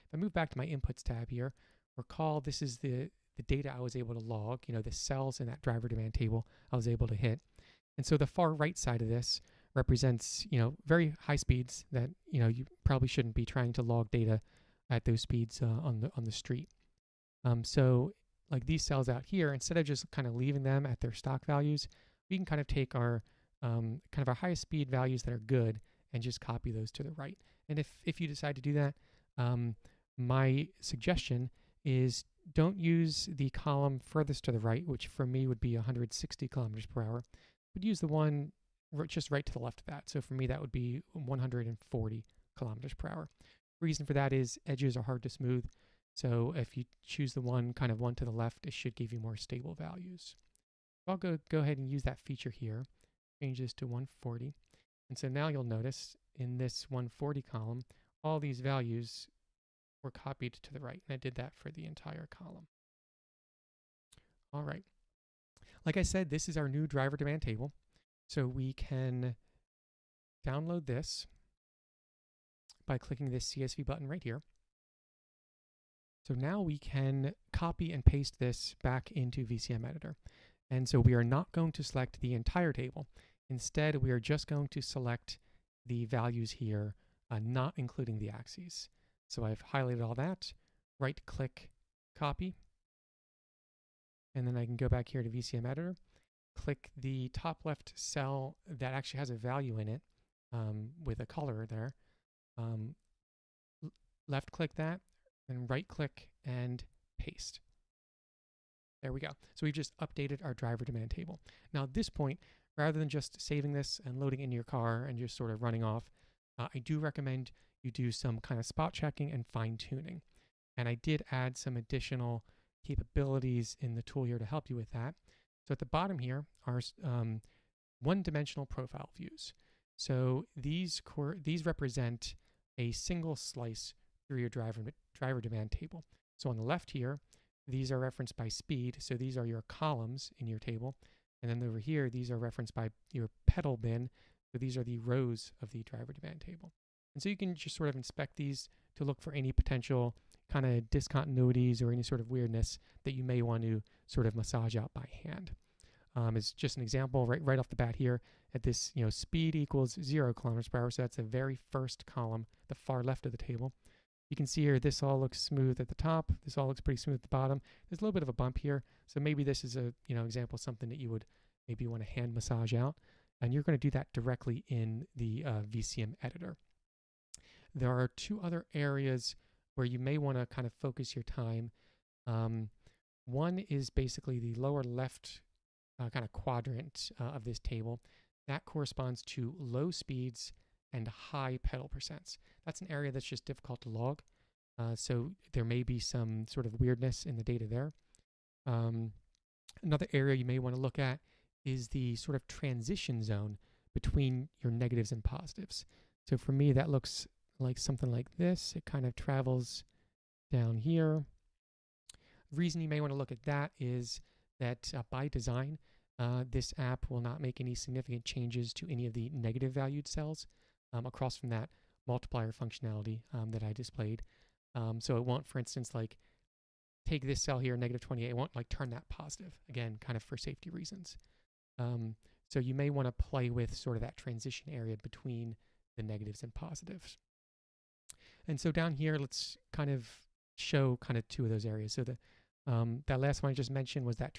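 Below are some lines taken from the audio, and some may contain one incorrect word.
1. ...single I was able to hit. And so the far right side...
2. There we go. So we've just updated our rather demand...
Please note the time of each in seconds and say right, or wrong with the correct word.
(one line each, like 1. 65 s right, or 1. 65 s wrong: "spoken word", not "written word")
1. 6 s wrong: "table", not "single"
2. 109 s wrong: "driver", not "rather".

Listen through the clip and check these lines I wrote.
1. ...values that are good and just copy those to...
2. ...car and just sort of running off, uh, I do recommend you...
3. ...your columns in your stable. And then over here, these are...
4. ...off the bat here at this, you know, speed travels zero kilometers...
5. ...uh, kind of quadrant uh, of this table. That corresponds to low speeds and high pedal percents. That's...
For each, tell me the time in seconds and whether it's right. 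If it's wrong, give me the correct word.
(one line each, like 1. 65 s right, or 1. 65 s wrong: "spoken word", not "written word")
1. 24 s right
2. 114 s right
3. 139 s wrong: "table", not "stable"
4. 157 s wrong: "equals", not "travels"
5. 185 s right.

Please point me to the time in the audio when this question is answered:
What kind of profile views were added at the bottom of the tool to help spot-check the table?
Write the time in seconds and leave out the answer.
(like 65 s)
128 s.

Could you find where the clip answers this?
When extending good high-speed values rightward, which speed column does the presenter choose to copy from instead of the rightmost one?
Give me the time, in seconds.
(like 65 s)
41 s.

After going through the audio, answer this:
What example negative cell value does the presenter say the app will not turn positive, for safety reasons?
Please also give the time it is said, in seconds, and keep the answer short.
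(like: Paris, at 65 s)
-28, at 227 s.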